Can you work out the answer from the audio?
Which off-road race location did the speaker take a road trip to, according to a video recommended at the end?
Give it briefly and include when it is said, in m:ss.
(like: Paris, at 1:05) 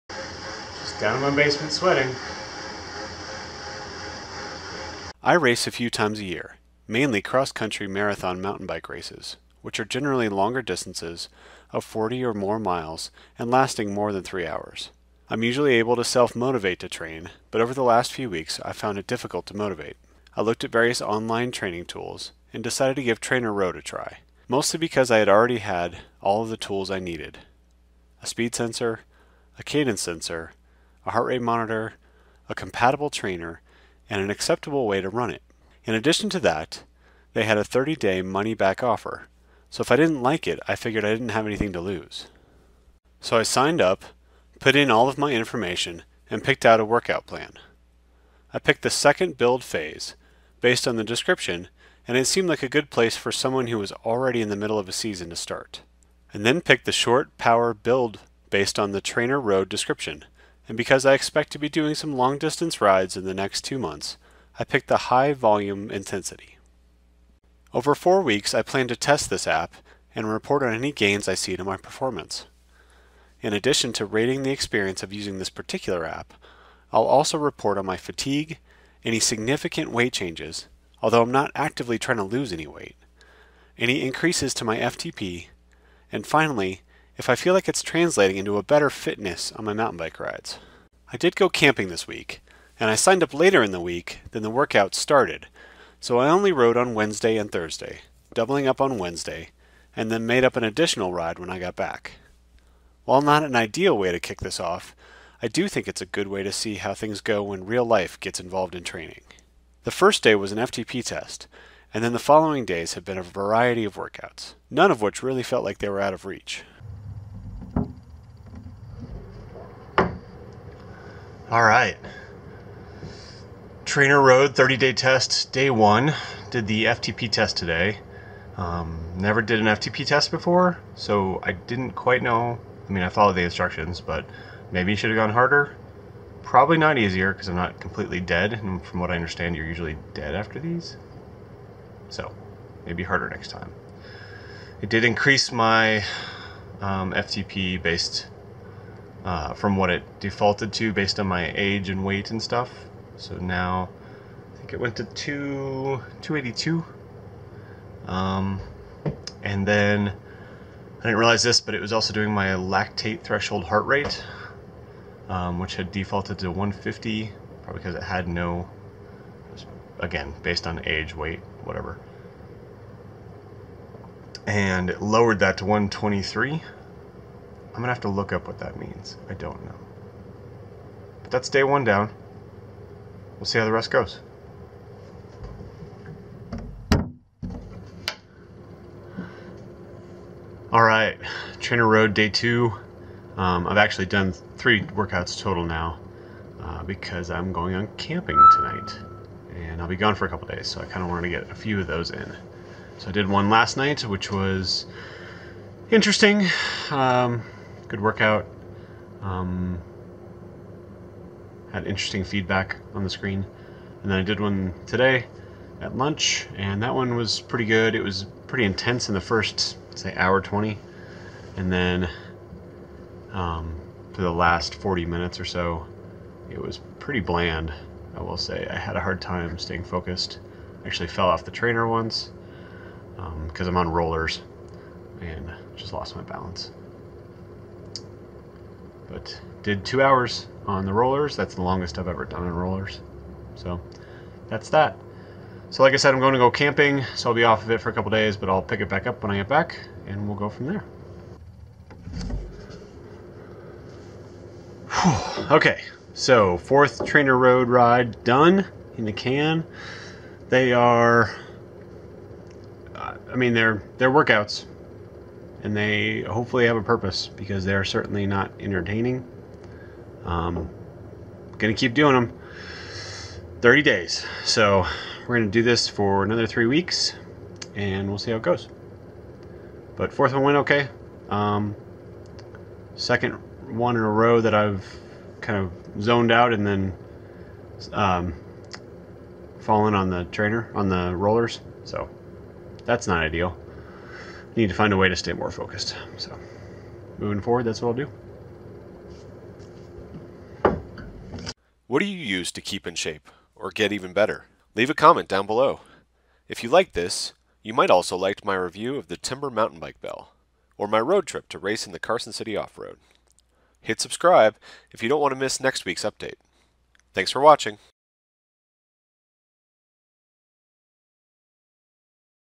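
Carson City, at 5:11.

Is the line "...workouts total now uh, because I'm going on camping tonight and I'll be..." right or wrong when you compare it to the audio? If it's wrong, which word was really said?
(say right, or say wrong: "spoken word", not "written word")
right.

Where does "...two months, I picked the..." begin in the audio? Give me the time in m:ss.
1:03.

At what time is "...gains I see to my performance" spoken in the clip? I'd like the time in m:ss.
1:10.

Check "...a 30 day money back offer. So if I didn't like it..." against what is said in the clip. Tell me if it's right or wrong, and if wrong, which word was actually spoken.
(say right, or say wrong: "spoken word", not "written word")
right.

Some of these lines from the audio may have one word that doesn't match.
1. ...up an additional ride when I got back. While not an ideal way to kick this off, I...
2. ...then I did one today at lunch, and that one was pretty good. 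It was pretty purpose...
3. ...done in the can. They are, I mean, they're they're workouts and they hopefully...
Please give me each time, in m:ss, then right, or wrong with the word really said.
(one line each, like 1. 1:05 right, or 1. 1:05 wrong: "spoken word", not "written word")
1. 1:40 right
2. 3:34 wrong: "intense", not "purpose"
3. 4:18 right.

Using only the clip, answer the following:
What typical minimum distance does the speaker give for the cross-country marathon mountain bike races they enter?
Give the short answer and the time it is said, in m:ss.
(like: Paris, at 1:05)
40 miles, at 0:11.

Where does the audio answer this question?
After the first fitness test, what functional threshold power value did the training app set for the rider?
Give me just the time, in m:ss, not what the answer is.
2:36.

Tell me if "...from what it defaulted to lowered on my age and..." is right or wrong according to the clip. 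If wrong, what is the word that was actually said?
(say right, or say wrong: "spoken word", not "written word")
wrong: "based", not "lowered".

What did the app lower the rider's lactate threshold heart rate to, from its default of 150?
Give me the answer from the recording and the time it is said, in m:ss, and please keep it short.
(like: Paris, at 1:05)
123, at 2:55.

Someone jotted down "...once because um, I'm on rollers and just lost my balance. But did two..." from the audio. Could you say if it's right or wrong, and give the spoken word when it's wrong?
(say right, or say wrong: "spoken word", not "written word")
right.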